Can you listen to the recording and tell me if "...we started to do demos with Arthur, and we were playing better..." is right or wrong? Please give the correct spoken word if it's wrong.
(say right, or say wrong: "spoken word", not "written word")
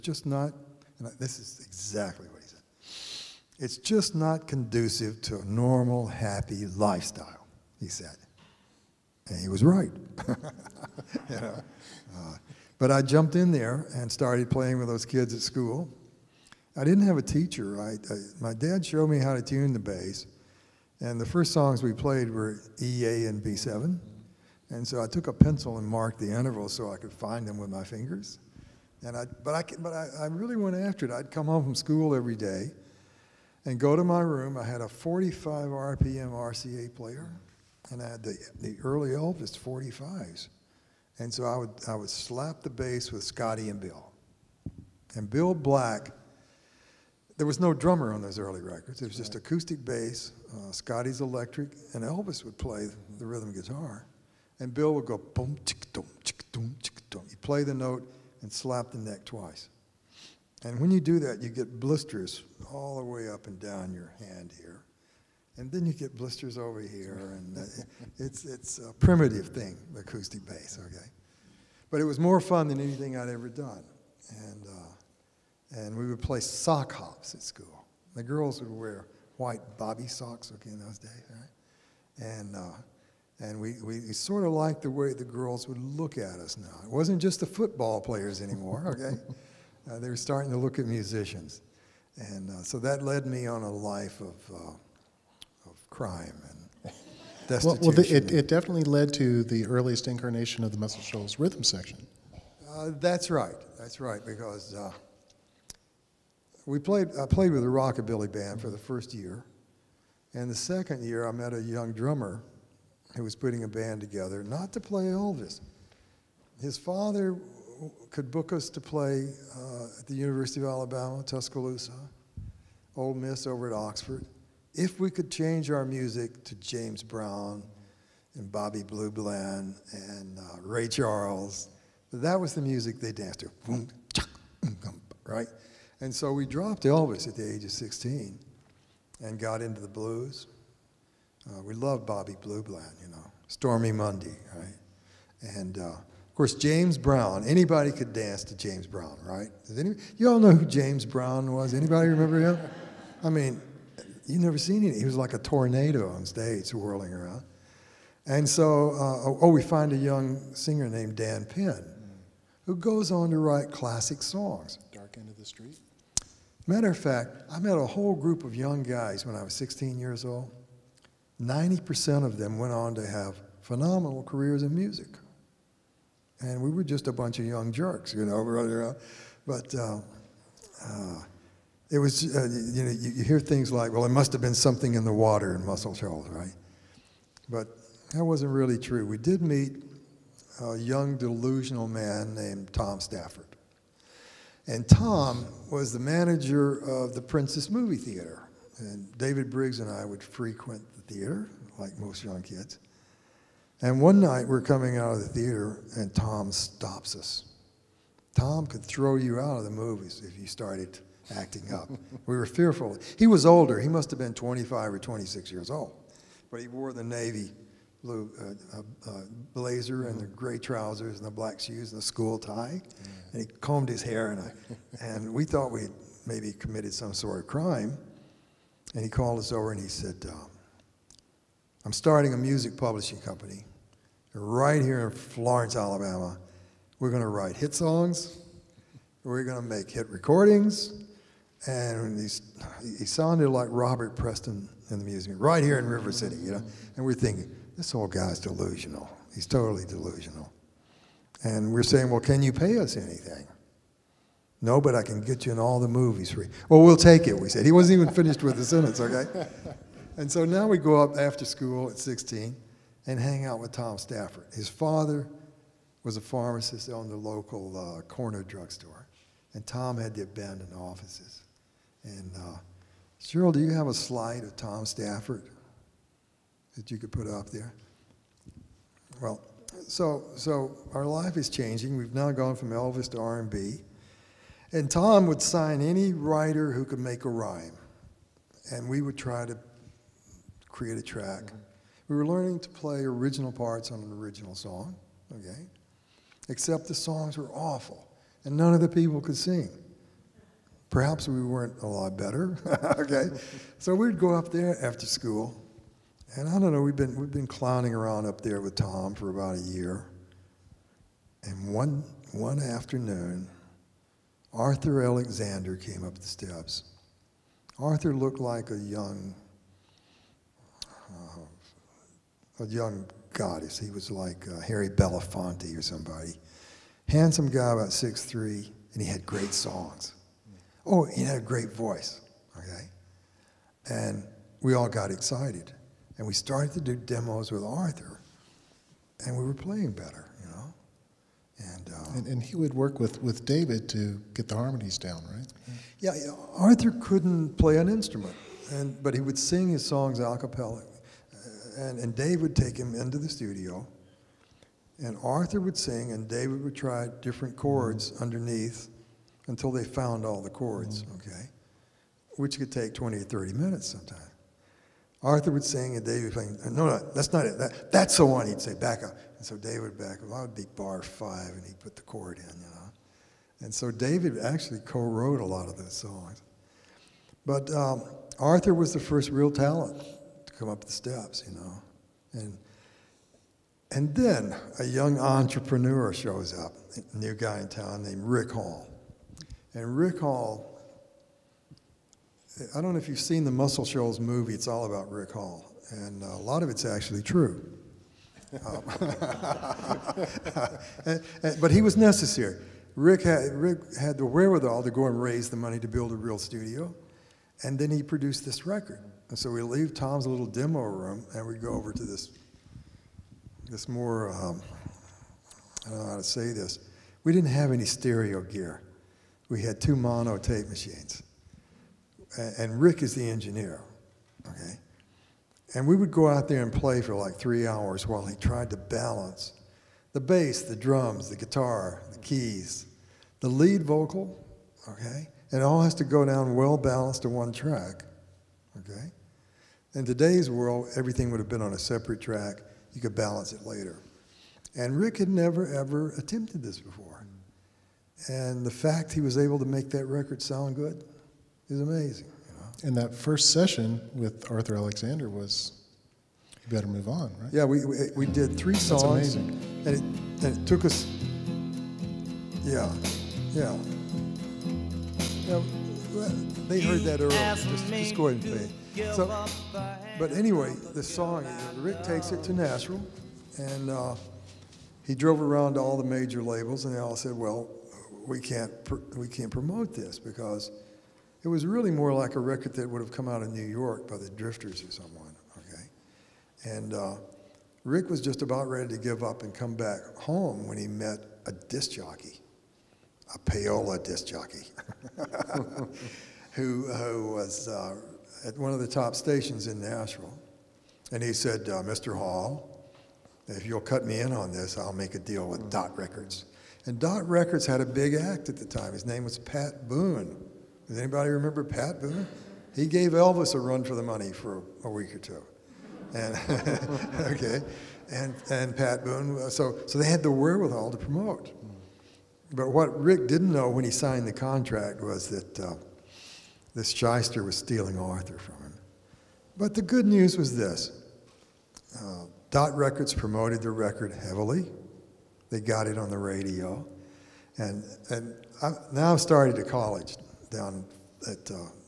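right.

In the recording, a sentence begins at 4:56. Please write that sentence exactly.
Except the songs were awful, and none of the people could sing.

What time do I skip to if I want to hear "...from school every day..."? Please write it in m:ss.
0:31.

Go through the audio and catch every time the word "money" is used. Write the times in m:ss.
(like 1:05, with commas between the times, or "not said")
6:45, 8:34.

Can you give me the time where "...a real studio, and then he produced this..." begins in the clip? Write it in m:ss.
6:46.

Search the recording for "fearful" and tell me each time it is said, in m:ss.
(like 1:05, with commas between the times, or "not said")
3:32.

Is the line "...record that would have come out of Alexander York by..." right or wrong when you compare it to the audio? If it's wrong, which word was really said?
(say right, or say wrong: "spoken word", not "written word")
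wrong: "New", not "Alexander".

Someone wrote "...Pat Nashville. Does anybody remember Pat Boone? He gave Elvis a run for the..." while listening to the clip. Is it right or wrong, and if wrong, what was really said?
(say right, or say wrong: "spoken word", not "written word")
wrong: "Boone", not "Nashville".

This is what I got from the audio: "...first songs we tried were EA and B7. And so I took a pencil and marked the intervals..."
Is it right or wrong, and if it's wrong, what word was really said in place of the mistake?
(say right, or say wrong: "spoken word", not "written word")
wrong: "played", not "tried".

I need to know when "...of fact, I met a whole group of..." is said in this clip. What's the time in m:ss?
2:46.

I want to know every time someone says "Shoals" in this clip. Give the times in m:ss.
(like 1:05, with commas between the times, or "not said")
1:41, 3:05, 6:33.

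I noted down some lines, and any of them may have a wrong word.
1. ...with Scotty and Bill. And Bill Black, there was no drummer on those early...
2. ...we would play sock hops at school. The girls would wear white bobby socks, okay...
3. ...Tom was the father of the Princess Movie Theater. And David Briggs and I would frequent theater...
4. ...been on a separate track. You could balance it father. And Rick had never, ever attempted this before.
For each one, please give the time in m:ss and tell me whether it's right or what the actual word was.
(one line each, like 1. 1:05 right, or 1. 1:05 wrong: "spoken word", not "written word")
1. 0:43 right
2. 1:15 right
3. 3:14 wrong: "manager", not "father"
4. 7:21 wrong: "later", not "father".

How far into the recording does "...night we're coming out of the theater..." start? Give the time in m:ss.
3:24.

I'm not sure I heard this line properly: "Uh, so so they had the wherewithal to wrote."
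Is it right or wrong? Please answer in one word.
wrong.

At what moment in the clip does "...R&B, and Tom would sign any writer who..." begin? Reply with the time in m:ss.
4:43.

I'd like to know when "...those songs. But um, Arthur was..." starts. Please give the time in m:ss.
6:15.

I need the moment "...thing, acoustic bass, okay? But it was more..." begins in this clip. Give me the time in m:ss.
1:09.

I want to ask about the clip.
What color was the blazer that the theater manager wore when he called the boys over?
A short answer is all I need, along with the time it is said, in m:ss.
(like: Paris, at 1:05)
navy blue, at 3:37.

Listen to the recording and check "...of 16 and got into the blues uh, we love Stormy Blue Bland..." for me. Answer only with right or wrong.
wrong.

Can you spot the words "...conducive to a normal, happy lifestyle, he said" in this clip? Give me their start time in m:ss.
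0:04.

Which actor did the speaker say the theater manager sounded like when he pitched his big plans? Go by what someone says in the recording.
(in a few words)
Robert Preston.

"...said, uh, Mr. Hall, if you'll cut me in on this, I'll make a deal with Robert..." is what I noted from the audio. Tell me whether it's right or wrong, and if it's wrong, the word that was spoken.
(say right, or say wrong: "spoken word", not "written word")
wrong: "Dot", not "Robert".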